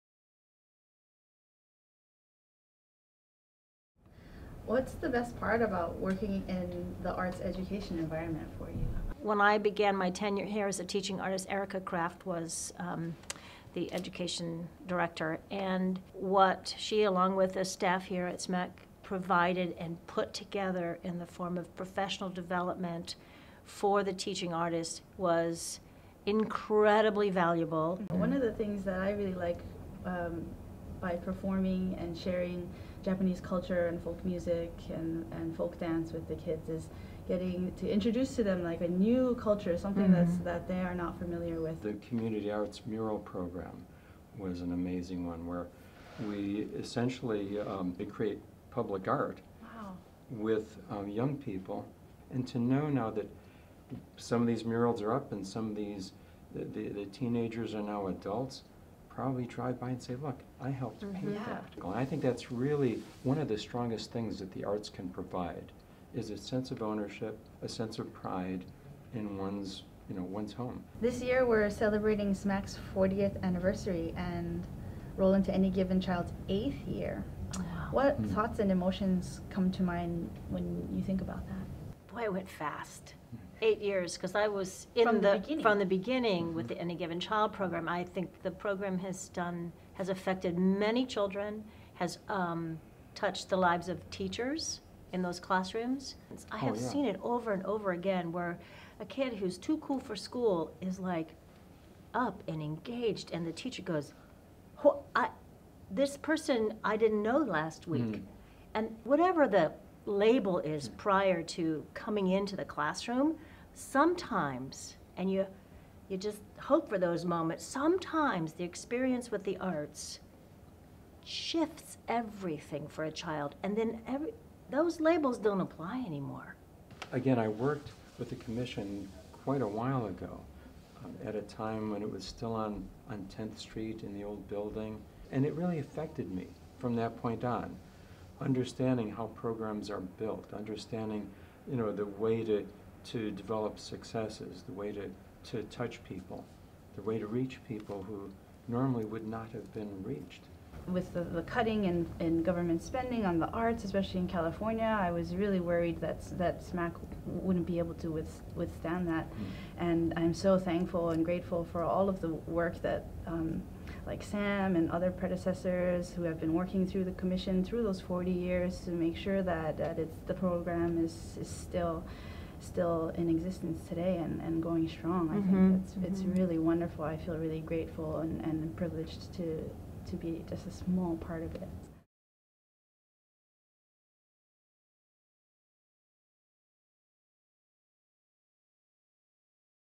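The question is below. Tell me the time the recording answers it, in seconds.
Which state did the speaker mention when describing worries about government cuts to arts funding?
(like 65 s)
154 s.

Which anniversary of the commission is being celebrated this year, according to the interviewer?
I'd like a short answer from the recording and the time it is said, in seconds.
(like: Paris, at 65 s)
40th, at 72 s.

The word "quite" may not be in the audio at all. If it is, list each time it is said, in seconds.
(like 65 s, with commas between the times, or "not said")
129 s.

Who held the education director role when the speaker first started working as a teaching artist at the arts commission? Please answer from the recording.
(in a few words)
Erica Kraft.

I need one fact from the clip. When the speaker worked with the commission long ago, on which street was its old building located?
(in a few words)
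10th Street.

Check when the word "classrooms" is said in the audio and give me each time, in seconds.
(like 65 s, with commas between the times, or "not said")
95 s, 112 s.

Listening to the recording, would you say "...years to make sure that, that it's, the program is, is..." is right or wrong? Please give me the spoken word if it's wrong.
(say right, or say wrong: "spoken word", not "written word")
right.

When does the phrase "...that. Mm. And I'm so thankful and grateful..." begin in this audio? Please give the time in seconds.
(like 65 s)
159 s.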